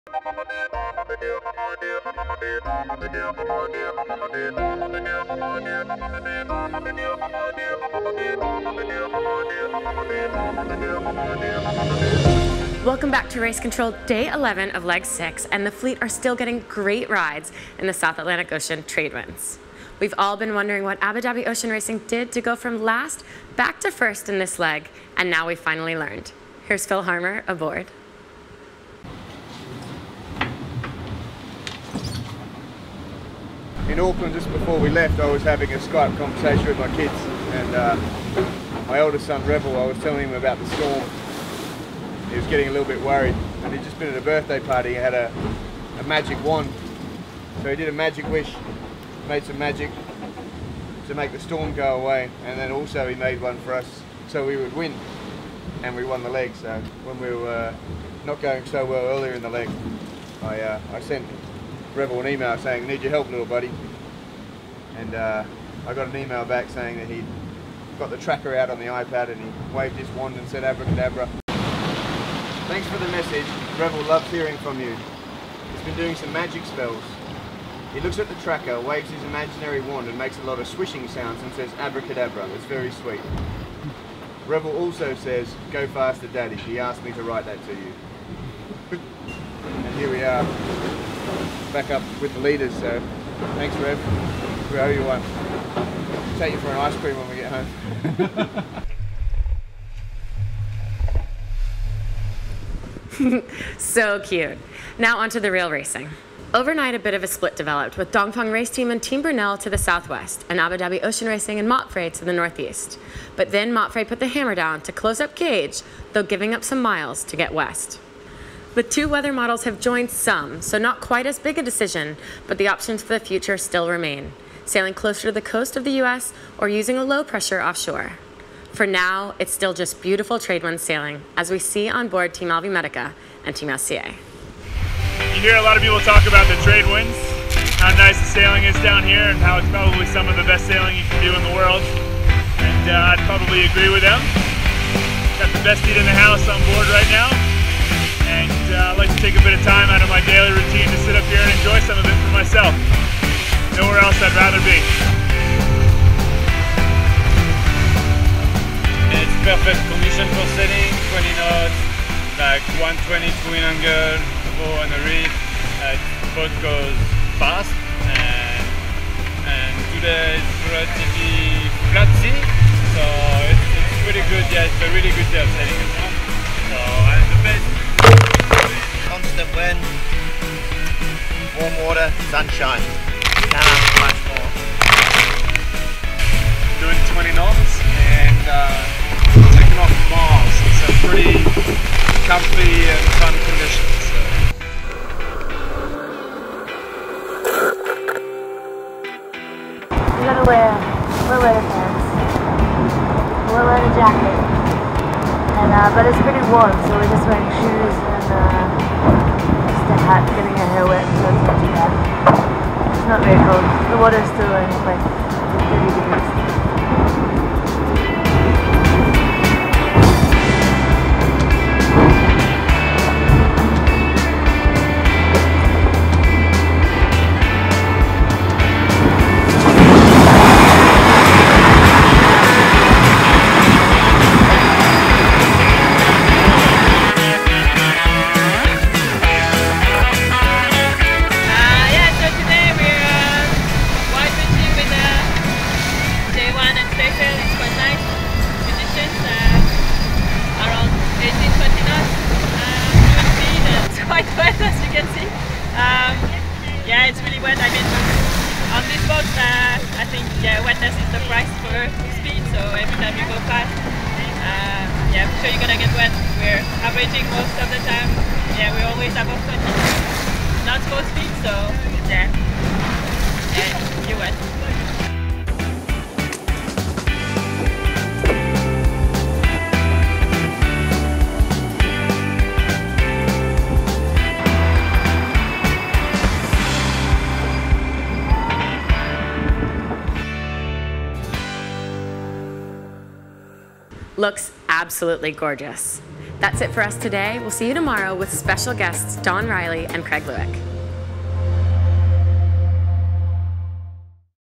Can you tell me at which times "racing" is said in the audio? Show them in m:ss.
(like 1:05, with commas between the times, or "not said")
0:21, 1:45, 1:51.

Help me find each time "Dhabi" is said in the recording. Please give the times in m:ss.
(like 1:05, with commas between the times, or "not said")
0:21, 1:50.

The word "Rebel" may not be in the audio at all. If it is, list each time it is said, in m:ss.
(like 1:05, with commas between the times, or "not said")
0:39, 1:01, 1:13, 1:24.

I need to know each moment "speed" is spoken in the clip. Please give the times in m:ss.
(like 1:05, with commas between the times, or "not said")
4:22, 4:31.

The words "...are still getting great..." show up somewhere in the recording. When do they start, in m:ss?
0:16.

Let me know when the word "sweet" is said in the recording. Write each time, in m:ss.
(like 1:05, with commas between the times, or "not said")
1:22.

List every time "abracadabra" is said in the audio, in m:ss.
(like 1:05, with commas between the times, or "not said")
1:10, 1:21.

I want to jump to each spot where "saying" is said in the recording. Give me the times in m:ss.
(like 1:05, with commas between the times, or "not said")
1:02, 1:06.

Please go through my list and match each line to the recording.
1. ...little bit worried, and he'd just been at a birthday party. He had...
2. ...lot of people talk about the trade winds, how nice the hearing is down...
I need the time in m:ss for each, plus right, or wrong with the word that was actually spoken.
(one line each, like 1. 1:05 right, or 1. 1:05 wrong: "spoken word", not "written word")
1. 0:42 right
2. 2:15 wrong: "sailing", not "hearing".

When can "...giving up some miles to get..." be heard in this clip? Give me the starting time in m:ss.
1:56.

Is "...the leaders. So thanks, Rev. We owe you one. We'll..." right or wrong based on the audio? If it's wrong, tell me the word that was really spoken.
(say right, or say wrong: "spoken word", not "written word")
right.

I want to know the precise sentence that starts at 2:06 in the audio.
or using a low pressure offshore.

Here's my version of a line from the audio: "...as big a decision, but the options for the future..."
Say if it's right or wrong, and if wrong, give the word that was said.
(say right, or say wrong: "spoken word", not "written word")
right.